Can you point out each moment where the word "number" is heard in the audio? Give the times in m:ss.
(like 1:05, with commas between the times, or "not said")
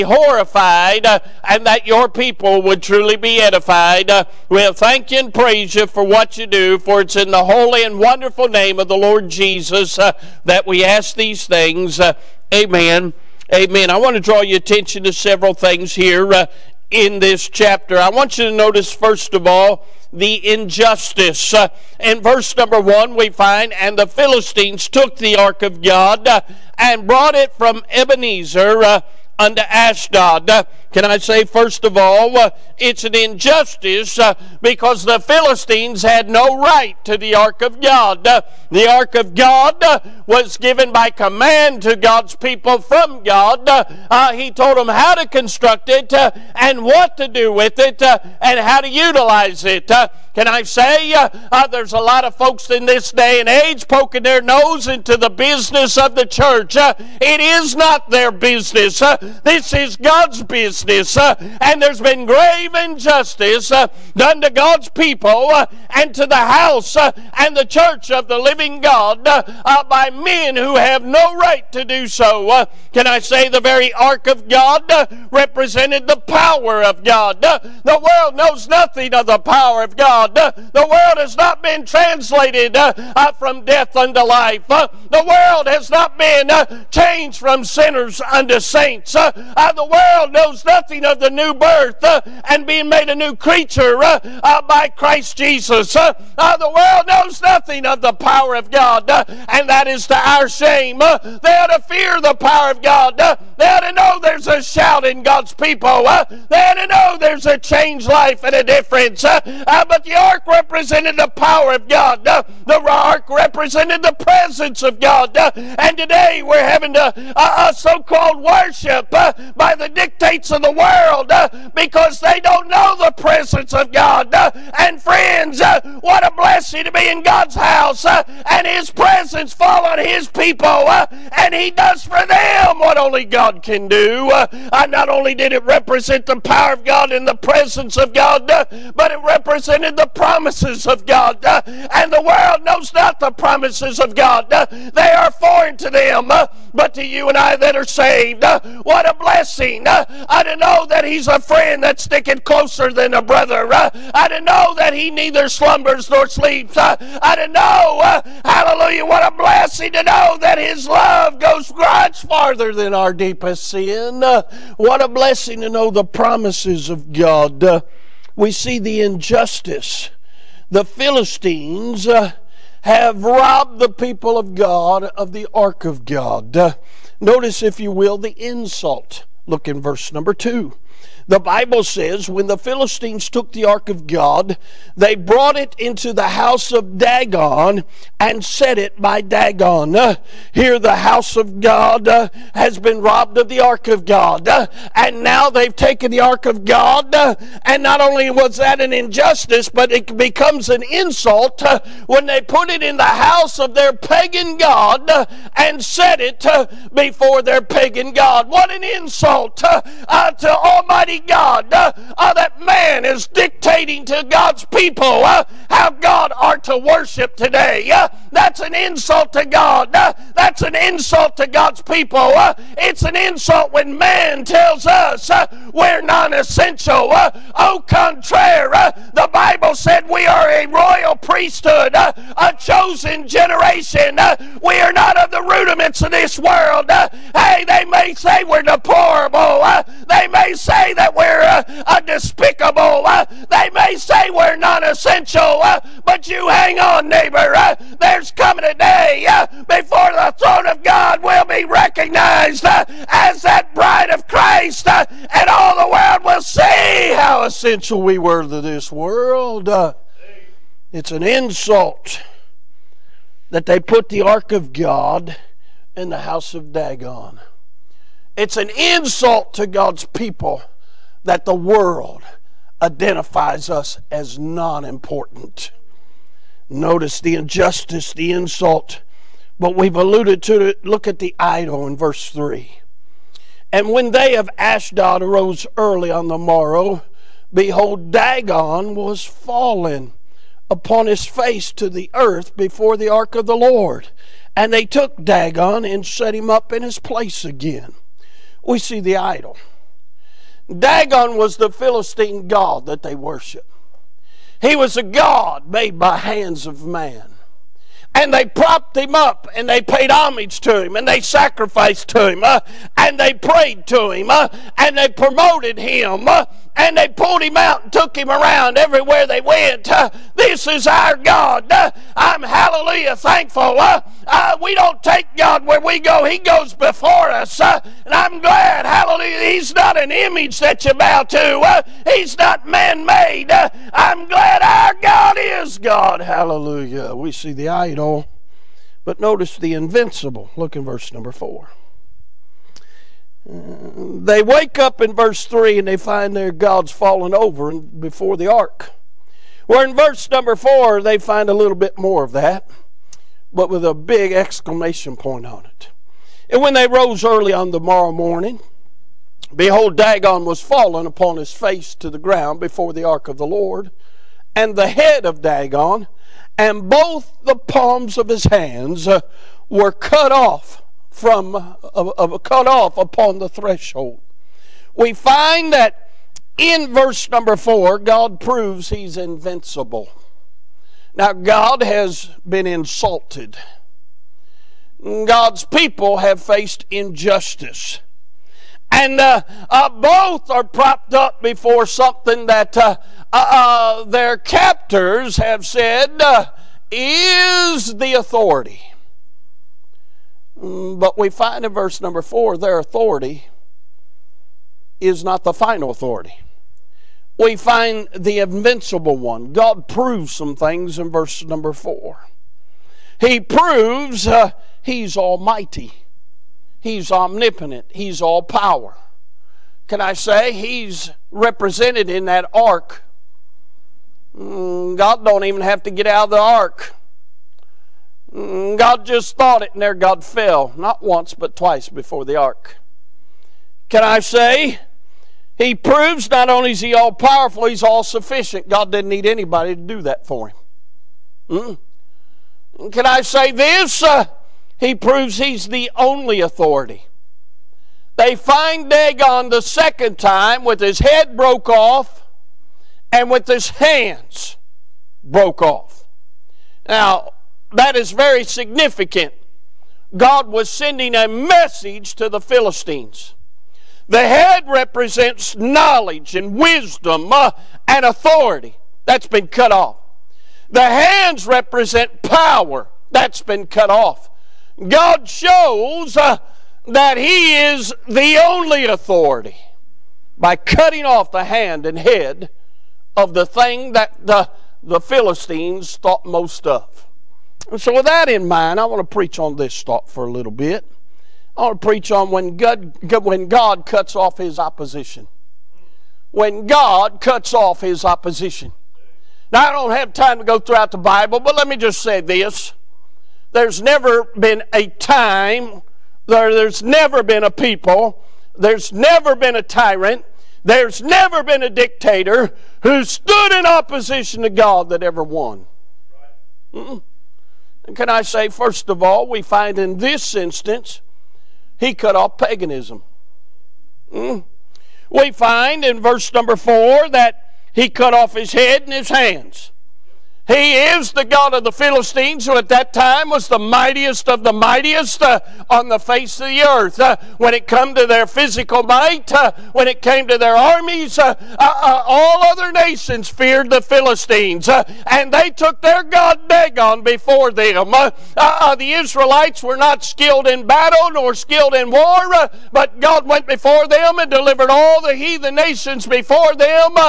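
0:22, 3:00, 5:41, 5:50, 6:17, 6:42, 6:51, 8:46.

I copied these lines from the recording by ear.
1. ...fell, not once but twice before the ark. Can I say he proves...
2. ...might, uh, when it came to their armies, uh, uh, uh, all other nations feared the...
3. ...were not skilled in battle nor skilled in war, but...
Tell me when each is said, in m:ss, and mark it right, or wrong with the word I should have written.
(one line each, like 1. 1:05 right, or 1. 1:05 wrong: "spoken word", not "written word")
1. 7:10 right
2. 8:58 right
3. 9:09 right.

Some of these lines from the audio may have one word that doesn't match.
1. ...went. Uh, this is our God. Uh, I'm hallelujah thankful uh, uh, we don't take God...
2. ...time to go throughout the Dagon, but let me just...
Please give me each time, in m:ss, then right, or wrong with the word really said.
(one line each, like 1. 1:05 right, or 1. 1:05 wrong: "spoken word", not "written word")
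1. 5:19 right
2. 8:20 wrong: "Bible", not "Dagon".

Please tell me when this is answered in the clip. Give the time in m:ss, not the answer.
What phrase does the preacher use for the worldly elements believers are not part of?
3:55.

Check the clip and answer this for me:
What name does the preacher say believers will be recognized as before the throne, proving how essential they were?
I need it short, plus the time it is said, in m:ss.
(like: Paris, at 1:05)
bride of Christ, at 4:13.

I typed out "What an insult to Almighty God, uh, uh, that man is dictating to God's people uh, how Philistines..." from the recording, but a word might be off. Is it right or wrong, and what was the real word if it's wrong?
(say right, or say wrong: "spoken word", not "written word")
wrong: "God", not "Philistines".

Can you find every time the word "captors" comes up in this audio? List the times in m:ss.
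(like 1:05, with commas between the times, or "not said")
6:34.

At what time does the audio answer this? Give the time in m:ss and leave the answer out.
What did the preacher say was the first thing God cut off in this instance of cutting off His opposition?
8:42.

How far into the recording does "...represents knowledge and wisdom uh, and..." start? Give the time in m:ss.
7:44.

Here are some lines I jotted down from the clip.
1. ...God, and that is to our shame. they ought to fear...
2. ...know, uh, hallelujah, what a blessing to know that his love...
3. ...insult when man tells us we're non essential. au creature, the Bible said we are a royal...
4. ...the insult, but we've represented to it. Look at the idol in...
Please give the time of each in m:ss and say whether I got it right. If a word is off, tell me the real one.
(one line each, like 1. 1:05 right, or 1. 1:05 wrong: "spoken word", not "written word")
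1. 1:38 right
2. 2:37 right
3. 3:43 wrong: "contraire", not "creature"
4. 4:38 wrong: "alluded", not "represented".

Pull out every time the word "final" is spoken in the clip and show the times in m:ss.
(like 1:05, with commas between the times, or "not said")
6:45.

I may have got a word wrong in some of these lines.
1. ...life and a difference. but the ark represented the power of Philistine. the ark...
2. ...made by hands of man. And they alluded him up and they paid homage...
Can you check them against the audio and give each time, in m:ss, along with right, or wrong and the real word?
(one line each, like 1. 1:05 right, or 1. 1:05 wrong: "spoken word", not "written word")
1. 1:48 wrong: "God", not "Philistine"
2. 5:05 wrong: "propped", not "alluded".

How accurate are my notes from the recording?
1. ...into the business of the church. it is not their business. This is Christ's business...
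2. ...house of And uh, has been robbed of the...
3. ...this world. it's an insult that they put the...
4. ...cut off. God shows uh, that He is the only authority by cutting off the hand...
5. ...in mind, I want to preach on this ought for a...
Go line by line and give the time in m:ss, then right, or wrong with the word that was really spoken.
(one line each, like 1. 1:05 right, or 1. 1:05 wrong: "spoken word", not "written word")
1. 0:54 wrong: "God", not "Christ"
2. 3:10 wrong: "God", not "And"
3. 4:18 right
4. 7:53 right
5. 8:08 wrong: "thought", not "ought".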